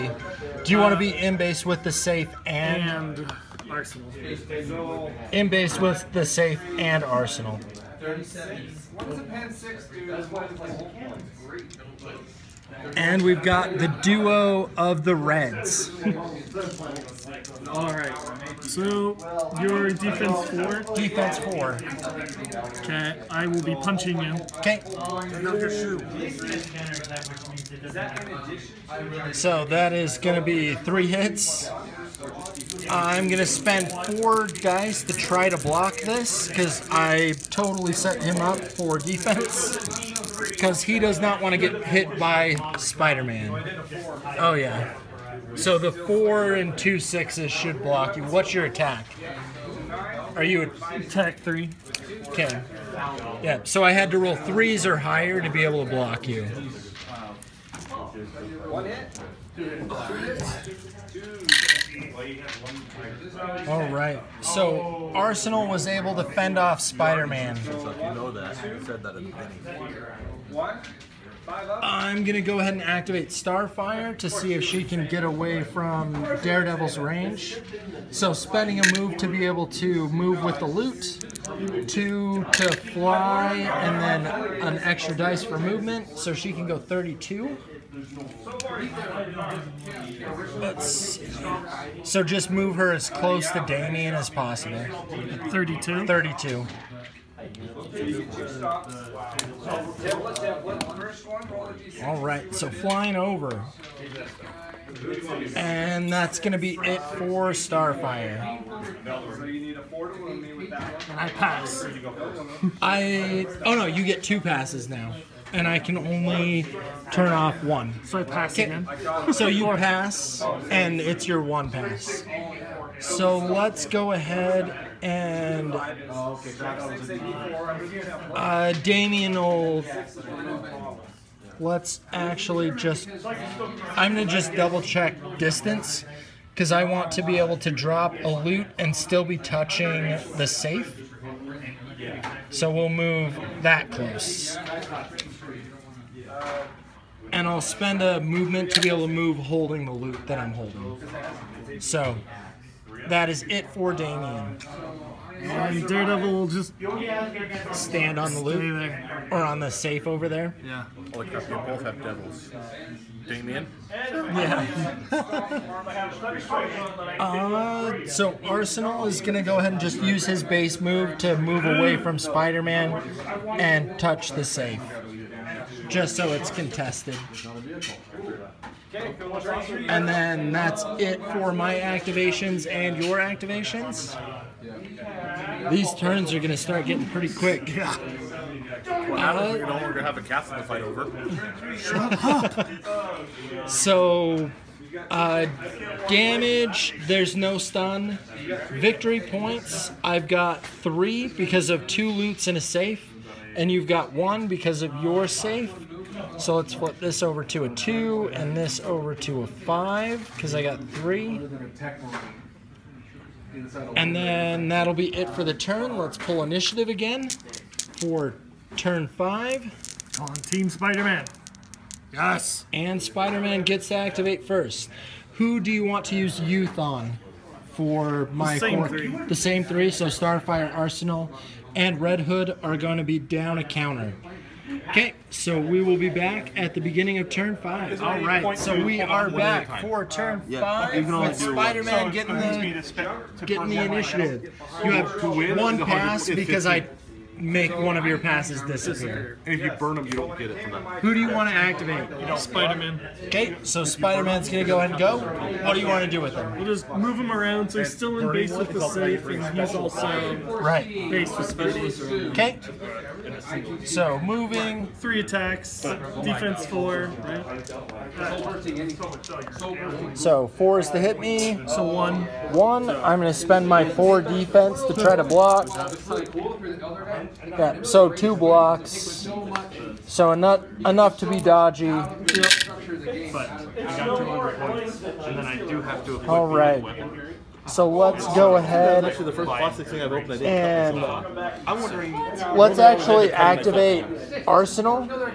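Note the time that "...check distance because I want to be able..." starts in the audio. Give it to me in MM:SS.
02:14.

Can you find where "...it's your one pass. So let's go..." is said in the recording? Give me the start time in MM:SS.
02:01.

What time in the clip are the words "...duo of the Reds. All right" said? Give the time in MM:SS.
00:14.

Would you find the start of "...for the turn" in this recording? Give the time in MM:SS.
03:35.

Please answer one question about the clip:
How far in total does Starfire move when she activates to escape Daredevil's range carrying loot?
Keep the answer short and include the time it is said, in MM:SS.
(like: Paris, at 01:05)
32, at 01:26.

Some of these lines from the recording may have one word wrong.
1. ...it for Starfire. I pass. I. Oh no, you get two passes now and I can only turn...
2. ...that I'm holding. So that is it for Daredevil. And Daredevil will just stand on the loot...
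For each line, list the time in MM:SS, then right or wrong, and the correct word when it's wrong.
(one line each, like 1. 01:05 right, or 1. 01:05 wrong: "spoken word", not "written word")
1. 01:46 right
2. 02:30 wrong: "Damian", not "Daredevil".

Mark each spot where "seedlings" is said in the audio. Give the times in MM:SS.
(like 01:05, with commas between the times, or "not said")
not said.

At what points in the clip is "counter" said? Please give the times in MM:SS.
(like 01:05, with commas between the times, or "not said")
03:53.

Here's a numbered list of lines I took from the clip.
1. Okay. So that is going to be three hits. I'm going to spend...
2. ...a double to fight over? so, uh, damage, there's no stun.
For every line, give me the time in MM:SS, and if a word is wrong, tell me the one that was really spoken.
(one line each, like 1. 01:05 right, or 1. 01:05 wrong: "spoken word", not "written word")
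1. 00:24 right
2. 03:10 wrong: "castle", not "double".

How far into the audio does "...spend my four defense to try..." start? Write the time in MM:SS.
04:33.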